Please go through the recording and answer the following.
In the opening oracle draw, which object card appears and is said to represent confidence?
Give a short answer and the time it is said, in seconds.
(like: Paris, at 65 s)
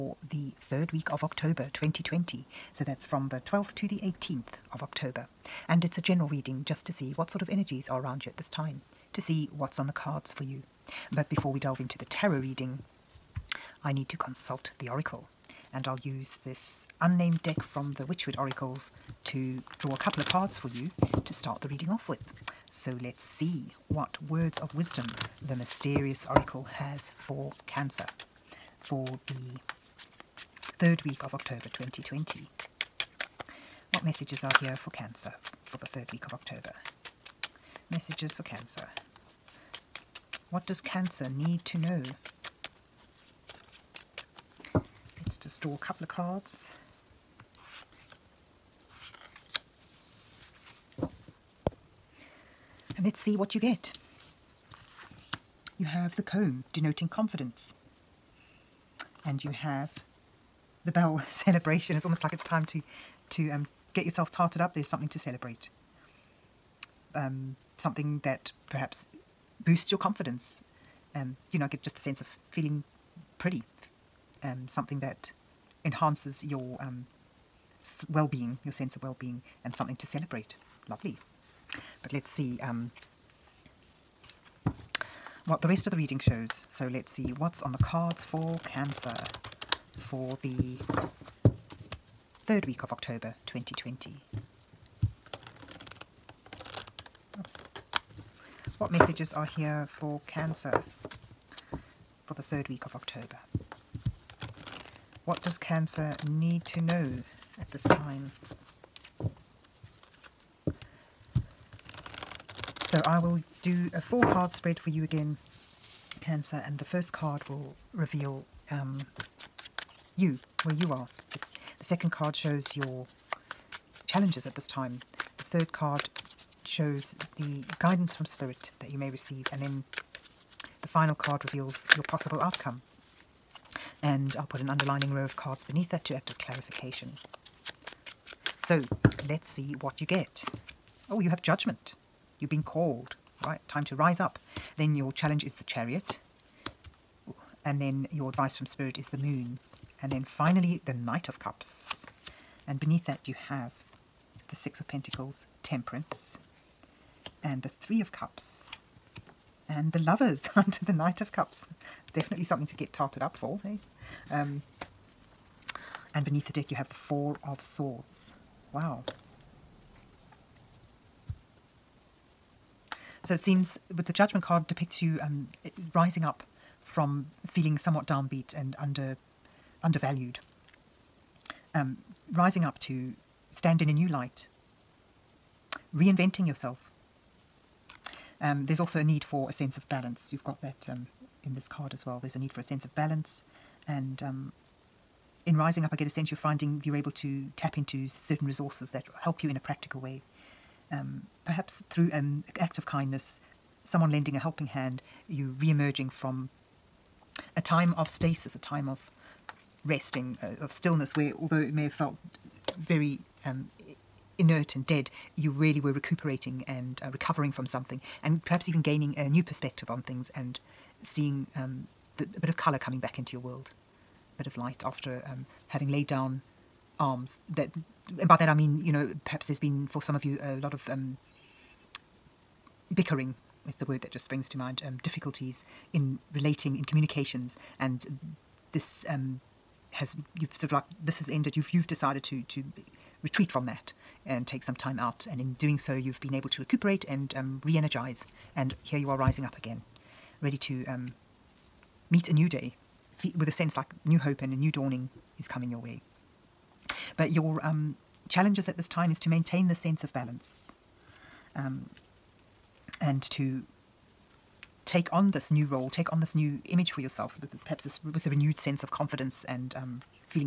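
The comb, at 56 s.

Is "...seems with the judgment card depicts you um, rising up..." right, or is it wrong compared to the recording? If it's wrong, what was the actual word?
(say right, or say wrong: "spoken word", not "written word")
right.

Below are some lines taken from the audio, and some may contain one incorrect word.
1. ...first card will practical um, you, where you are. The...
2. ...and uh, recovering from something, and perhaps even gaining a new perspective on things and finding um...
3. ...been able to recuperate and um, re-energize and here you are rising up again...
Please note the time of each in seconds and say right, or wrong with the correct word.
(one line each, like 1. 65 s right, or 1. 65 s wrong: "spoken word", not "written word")
1. 116 s wrong: "reveal", not "practical"
2. 216 s wrong: "seeing", not "finding"
3. 246 s right.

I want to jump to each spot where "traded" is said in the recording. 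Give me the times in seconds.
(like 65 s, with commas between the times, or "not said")
not said.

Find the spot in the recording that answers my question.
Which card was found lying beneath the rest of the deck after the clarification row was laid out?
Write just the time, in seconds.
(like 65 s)
166 s.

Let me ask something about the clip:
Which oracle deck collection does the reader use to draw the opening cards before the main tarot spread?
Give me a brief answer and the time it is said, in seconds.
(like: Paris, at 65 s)
Wychwood Oracles, at 18 s.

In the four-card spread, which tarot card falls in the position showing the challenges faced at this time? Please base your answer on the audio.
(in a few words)
The Chariot.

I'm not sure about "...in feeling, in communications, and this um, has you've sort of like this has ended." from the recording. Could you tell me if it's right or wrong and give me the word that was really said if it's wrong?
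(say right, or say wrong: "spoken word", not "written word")
wrong: "relating", not "feeling".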